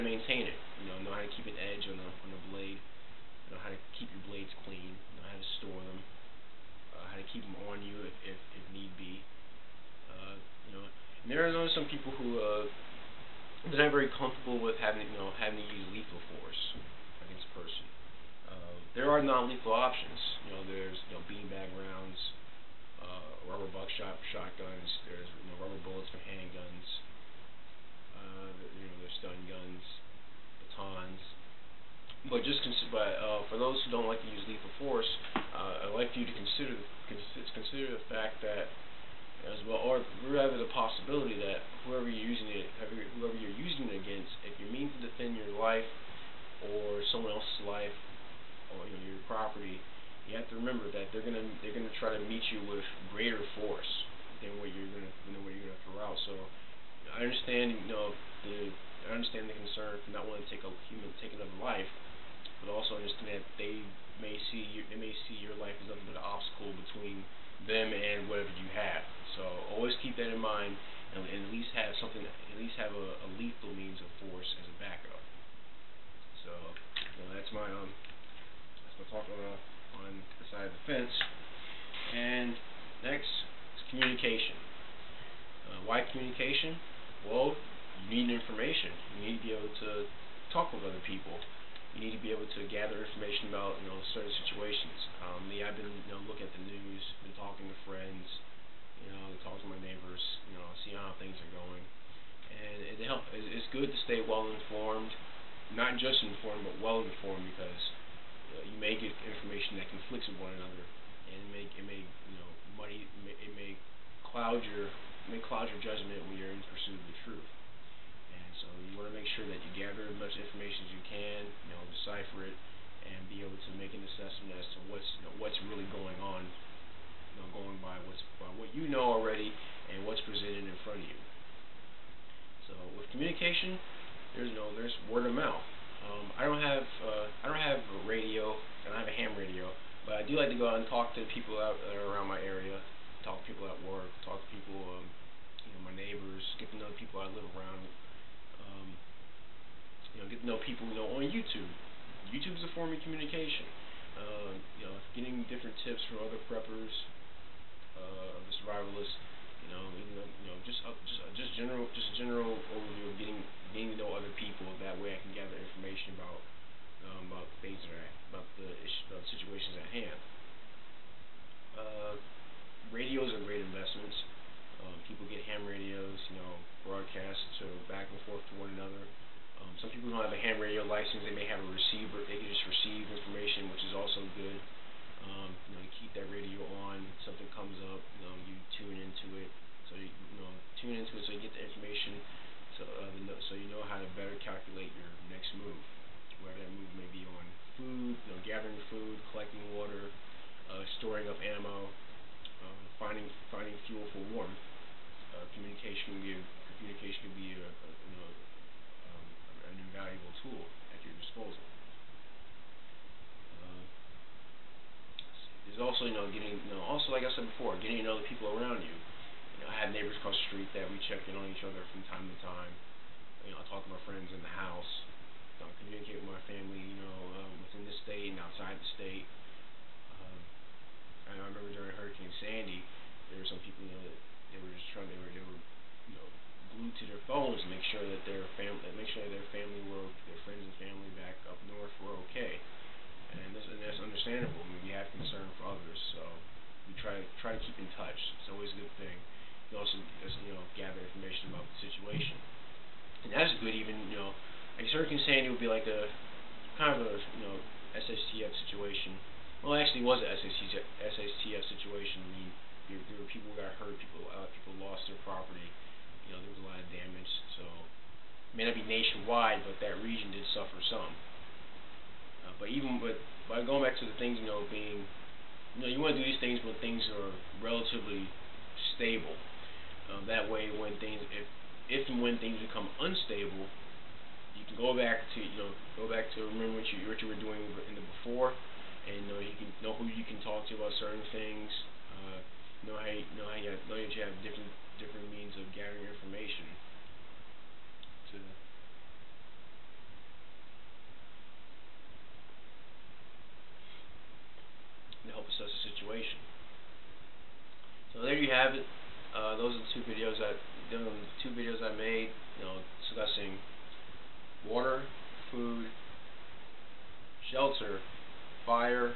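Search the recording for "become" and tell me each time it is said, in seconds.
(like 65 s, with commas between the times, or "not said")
282 s.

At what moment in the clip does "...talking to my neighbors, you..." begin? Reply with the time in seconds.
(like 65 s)
99 s.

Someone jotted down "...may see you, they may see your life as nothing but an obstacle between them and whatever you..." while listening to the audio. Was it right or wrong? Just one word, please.
right.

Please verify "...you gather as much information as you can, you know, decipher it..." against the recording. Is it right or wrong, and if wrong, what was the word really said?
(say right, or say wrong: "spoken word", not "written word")
right.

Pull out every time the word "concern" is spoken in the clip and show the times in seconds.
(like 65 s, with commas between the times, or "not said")
59 s, 245 s.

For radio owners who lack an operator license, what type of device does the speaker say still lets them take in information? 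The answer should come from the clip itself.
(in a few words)
A receiver.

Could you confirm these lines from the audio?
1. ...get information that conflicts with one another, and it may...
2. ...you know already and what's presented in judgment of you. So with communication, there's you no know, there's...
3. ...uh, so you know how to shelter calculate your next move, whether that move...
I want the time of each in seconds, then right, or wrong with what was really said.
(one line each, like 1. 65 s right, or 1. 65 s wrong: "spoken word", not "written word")
1. 108 s right
2. 128 s wrong: "front", not "judgment"
3. 192 s wrong: "better", not "shelter".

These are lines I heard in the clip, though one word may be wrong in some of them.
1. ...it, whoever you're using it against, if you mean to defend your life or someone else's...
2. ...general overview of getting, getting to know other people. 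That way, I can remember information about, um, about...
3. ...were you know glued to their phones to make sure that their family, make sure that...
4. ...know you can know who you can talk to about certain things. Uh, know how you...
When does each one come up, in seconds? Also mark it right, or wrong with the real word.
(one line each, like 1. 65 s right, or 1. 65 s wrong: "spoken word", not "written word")
1. 42 s right
2. 162 s wrong: "gather", not "remember"
3. 235 s right
4. 289 s right.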